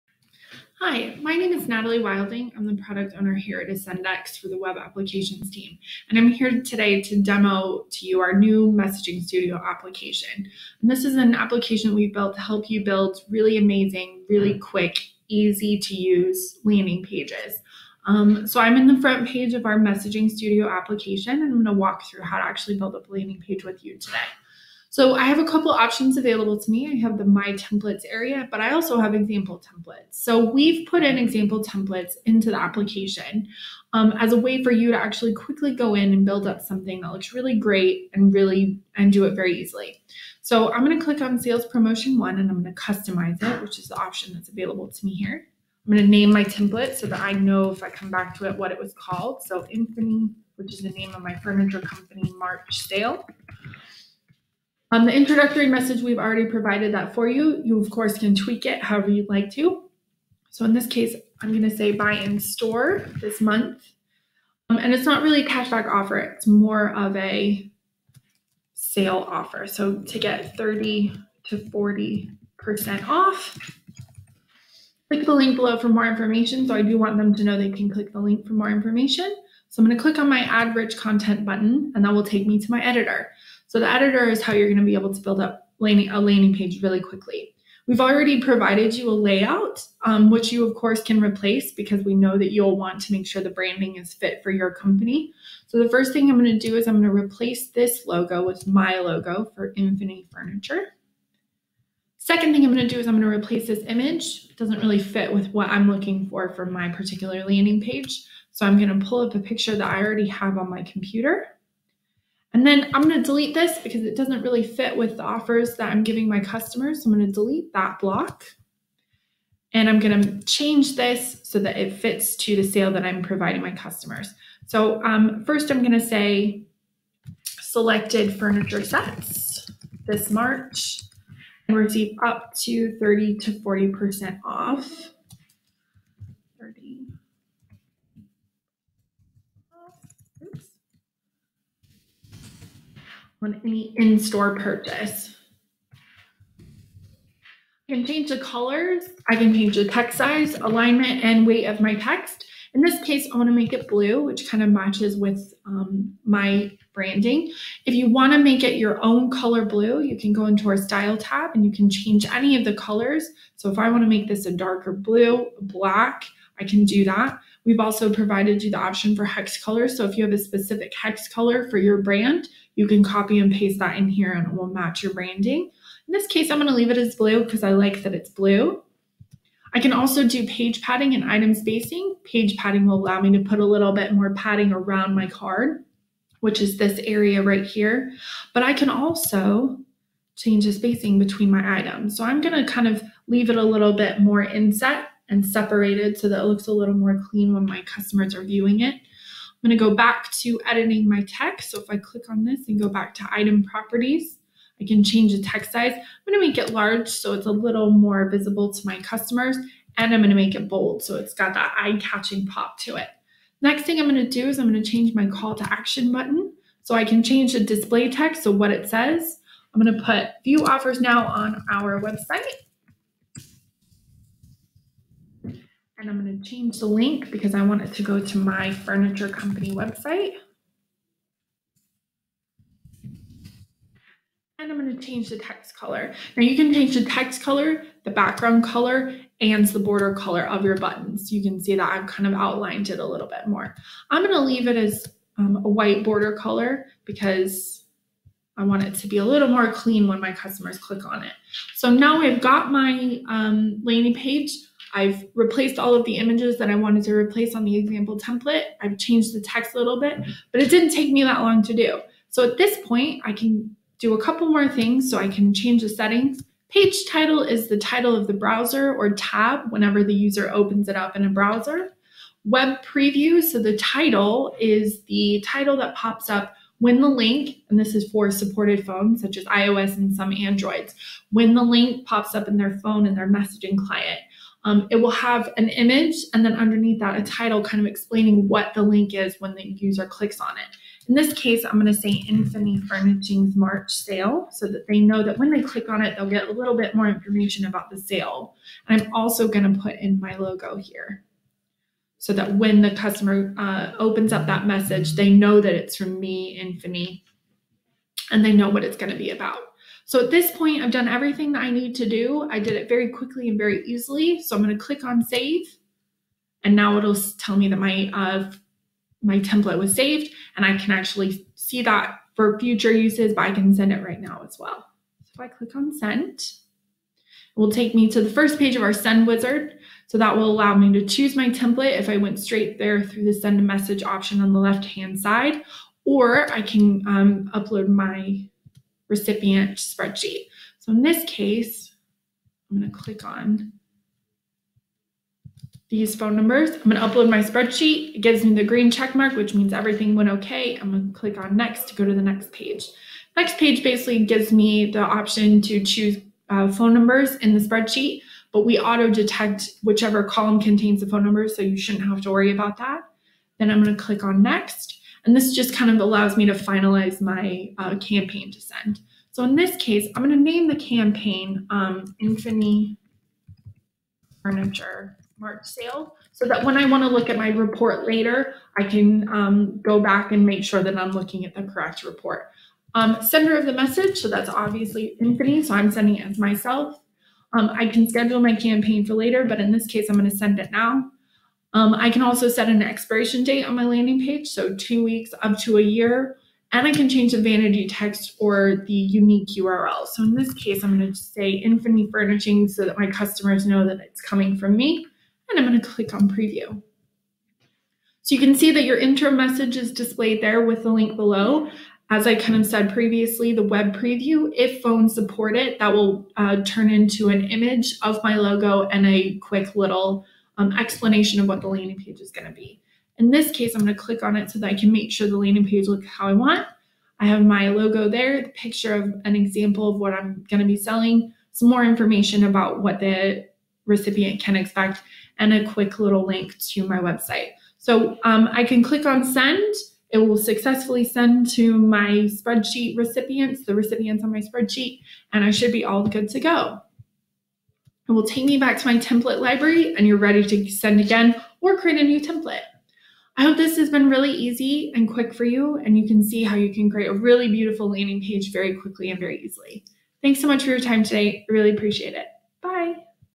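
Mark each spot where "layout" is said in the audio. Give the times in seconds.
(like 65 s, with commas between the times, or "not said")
89 s.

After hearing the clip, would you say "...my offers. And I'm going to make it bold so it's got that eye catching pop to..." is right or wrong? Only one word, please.
wrong.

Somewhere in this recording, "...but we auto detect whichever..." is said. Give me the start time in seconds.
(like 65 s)
358 s.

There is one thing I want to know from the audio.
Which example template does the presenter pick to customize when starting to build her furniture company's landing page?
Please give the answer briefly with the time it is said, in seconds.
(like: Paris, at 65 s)
Sales Promotion 1, at 41 s.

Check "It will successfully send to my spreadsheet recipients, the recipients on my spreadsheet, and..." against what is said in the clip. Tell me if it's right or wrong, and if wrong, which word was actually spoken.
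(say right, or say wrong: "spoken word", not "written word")
right.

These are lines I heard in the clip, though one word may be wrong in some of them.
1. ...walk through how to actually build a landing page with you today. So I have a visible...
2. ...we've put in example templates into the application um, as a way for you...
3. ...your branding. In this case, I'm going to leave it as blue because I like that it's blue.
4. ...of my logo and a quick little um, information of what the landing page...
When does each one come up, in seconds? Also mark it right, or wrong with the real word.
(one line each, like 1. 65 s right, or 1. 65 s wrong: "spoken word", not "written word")
1. 21 s wrong: "couple", not "visible"
2. 30 s right
3. 175 s right
4. 418 s wrong: "explanation", not "information".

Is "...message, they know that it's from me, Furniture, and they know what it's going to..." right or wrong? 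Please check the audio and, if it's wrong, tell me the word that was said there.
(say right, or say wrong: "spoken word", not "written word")
wrong: "Infini", not "Furniture".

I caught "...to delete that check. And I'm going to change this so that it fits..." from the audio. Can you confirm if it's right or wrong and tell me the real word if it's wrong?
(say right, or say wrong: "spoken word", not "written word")
wrong: "block", not "check".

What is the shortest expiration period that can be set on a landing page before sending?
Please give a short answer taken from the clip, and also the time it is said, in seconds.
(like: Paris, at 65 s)
Two weeks, at 394 s.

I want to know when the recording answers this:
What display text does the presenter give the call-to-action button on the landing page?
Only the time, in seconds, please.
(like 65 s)
220 s.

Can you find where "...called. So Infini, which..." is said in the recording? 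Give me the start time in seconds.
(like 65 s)
48 s.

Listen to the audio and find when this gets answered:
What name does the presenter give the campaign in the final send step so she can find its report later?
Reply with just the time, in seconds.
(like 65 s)
372 s.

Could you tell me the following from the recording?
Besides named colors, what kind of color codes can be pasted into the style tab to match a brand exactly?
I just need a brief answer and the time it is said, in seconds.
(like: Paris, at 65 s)
Hex colors, at 169 s.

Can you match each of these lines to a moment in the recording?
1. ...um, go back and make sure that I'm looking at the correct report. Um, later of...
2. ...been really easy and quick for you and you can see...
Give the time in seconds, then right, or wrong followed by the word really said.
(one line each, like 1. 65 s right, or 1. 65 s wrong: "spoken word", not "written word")
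1. 379 s wrong: "sender", not "later"
2. 453 s right.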